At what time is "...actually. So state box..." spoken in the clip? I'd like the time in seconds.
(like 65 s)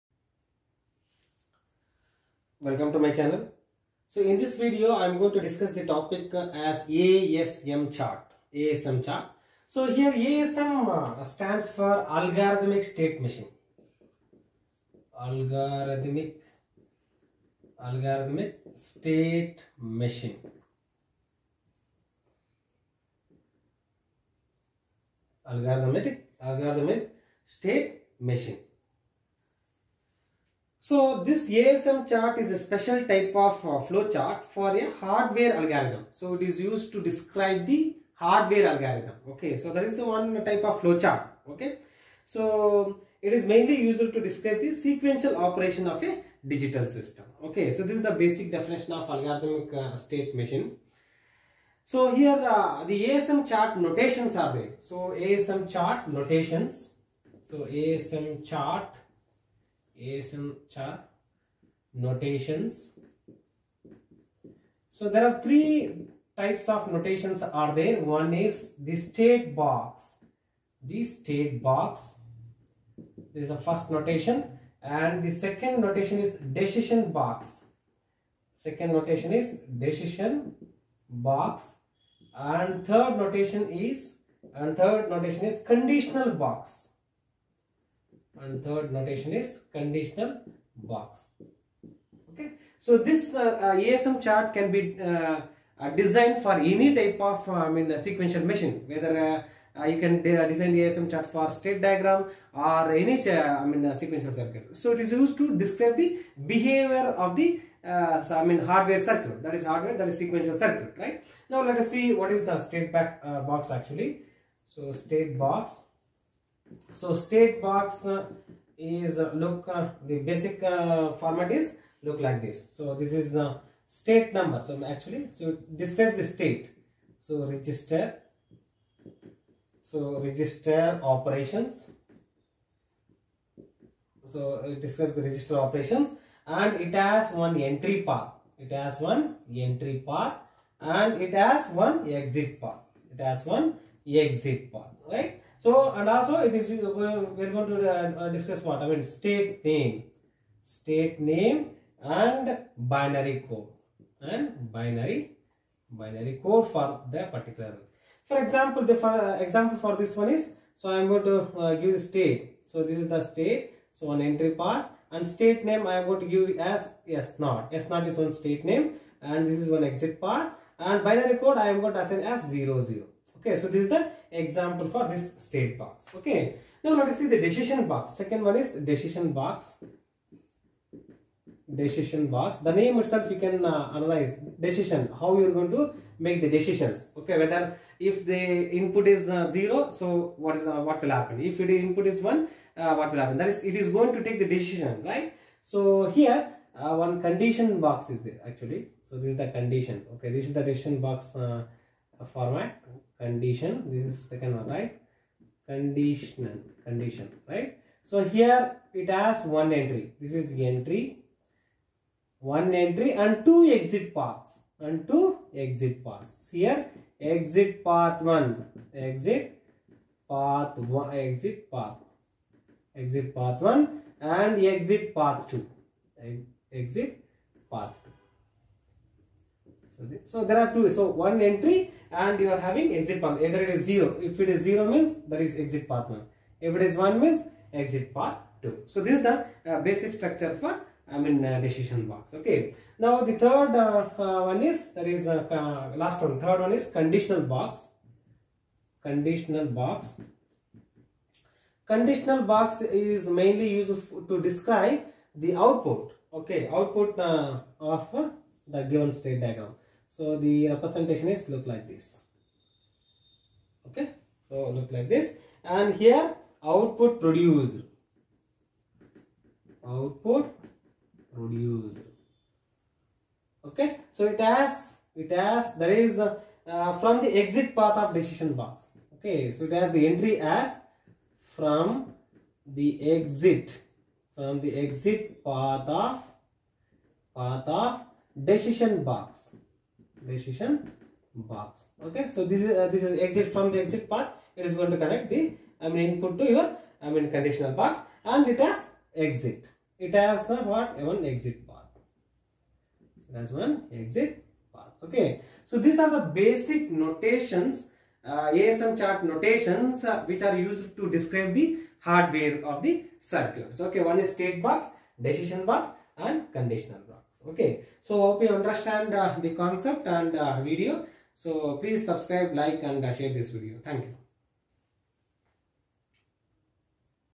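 113 s.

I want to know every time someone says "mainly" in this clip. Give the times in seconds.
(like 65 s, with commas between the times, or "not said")
43 s, 253 s.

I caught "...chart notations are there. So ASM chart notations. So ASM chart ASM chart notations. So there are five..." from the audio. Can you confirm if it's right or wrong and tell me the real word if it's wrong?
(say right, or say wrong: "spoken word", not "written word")
wrong: "three", not "five".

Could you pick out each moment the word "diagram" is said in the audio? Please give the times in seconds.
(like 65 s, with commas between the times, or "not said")
101 s, 259 s.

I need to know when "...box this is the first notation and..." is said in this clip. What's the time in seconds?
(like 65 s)
71 s.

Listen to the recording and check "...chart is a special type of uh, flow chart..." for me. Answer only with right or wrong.
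right.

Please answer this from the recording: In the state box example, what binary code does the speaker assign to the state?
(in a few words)
00.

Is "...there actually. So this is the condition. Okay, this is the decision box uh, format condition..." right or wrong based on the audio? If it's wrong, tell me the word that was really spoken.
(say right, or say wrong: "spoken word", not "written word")
right.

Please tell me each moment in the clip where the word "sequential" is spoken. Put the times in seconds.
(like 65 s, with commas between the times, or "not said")
44 s, 98 s, 103 s, 110 s.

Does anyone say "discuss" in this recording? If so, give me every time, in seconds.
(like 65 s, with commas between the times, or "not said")
5 s, 148 s.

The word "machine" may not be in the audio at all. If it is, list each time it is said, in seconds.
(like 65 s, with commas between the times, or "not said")
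13 s, 20 s, 28 s, 50 s, 98 s.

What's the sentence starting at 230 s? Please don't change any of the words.
So one entry and you are having exit path.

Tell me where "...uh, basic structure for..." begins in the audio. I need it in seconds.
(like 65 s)
239 s.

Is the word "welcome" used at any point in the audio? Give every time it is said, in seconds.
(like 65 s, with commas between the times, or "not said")
2 s.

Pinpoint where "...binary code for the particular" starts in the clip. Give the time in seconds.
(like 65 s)
155 s.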